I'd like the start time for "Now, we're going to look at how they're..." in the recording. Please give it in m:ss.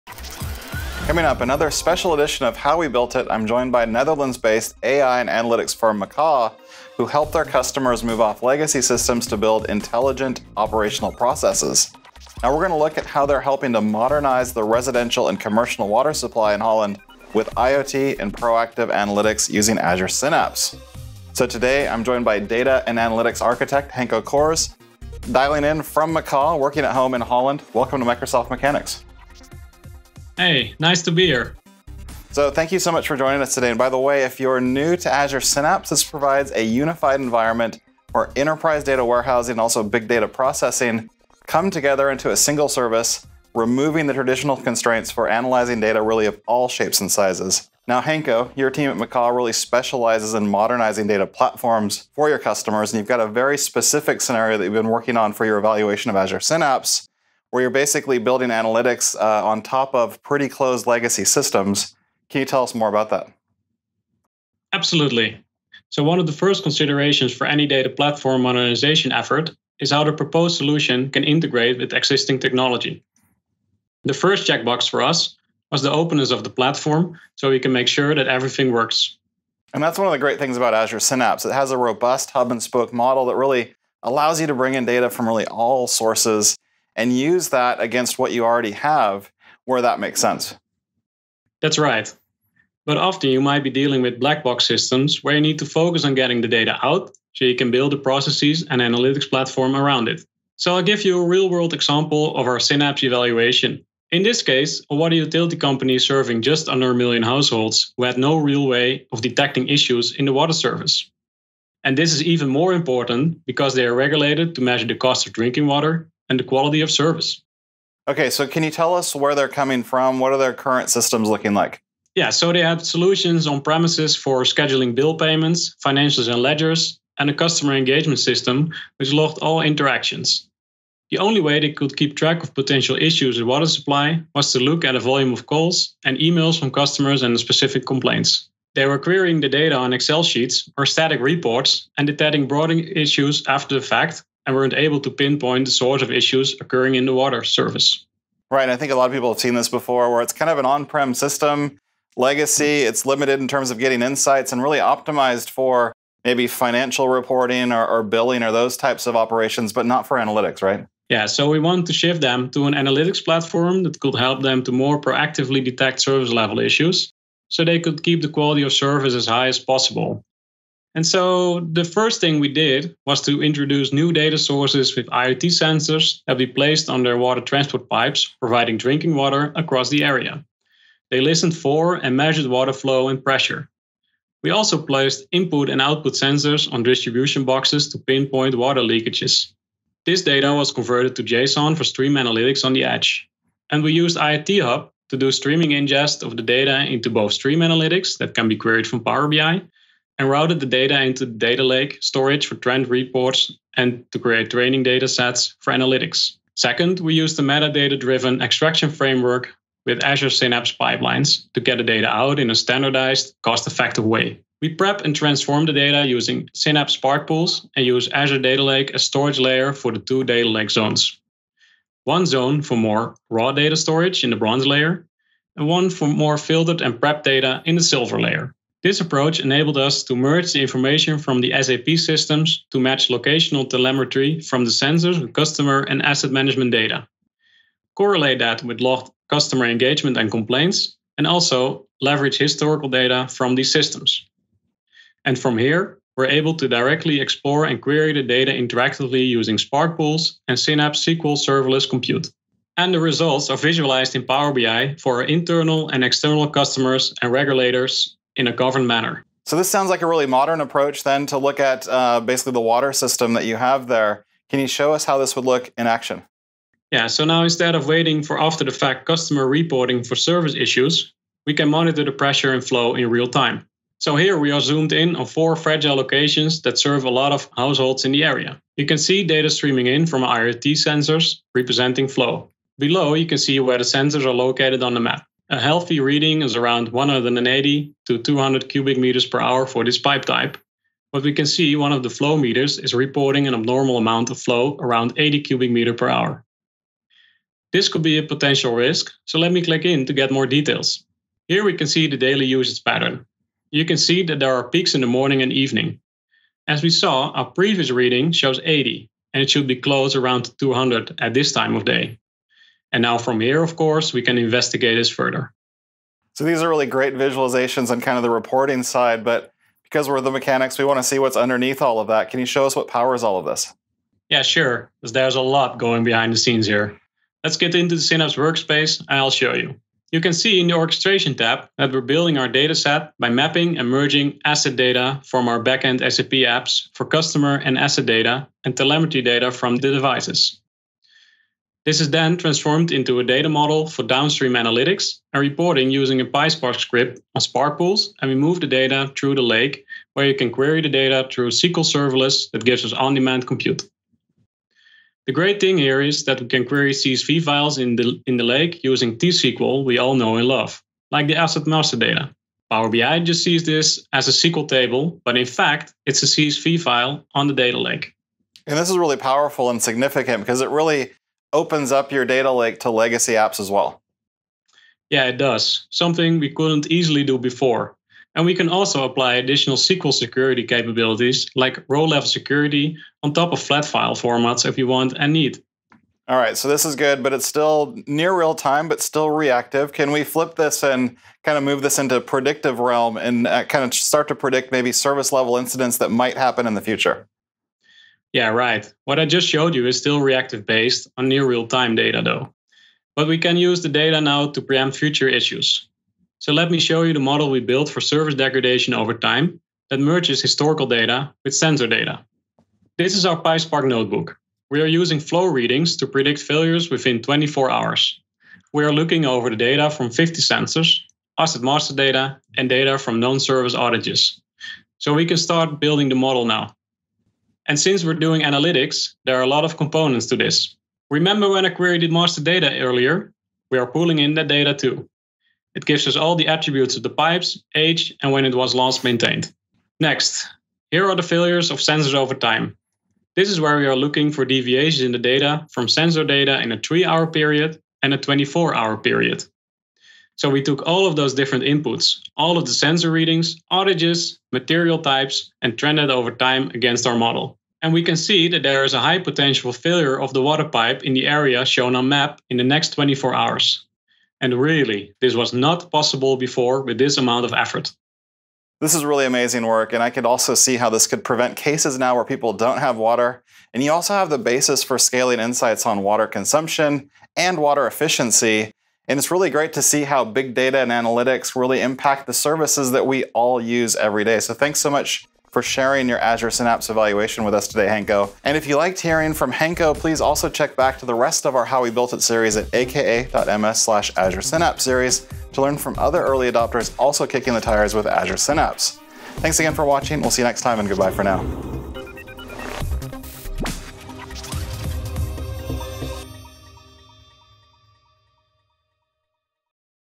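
0:12.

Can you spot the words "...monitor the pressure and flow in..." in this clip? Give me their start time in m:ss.
4:31.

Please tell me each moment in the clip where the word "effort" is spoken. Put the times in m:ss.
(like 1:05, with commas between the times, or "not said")
1:09, 7:47.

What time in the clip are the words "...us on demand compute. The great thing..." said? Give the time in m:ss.
5:52.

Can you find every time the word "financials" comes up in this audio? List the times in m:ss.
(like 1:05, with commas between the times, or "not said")
2:05, 2:36.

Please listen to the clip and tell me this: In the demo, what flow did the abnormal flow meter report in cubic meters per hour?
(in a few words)
80.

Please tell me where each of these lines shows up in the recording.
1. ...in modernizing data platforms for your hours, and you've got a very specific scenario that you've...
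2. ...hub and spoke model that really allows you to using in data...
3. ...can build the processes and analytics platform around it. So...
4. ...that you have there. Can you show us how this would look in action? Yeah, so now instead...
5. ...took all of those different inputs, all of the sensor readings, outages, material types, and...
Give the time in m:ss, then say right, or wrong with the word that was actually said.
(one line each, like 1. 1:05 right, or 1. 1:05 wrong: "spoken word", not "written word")
1. 0:50 wrong: "customers", not "hours"
2. 1:22 wrong: "bring", not "using"
3. 1:37 right
4. 4:23 right
5. 7:30 right.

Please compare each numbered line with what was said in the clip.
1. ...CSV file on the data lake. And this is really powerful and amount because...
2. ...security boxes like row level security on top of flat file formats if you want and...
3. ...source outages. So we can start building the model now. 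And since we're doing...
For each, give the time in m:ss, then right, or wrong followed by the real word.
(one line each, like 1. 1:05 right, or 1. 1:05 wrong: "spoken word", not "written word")
1. 6:06 wrong: "significant", not "amount"
2. 6:20 wrong: "capabilities", not "boxes"
3. 7:03 wrong: "service", not "source".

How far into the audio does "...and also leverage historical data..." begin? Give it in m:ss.
4:01.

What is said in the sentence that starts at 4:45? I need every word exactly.
A healthy reading is around 180 to 200 cubic meters per hour for this pipe type.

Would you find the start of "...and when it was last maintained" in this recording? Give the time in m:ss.
7:18.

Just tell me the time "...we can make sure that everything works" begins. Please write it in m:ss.
1:17.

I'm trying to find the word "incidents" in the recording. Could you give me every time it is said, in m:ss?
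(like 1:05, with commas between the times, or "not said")
6:35.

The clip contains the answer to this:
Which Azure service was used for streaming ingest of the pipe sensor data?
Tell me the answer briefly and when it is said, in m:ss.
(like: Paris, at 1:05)
IoT Hub, at 3:14.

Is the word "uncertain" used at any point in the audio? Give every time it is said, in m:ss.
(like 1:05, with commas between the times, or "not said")
not said.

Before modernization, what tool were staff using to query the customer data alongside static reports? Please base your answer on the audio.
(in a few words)
Excel sheets.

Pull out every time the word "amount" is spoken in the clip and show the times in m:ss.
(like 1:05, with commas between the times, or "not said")
4:53, 7:47.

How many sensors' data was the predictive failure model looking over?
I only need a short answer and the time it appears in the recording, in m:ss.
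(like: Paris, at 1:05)
50, at 7:00.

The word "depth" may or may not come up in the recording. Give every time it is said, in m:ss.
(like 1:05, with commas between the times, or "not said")
not said.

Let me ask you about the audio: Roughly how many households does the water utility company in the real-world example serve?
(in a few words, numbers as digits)
just under a million.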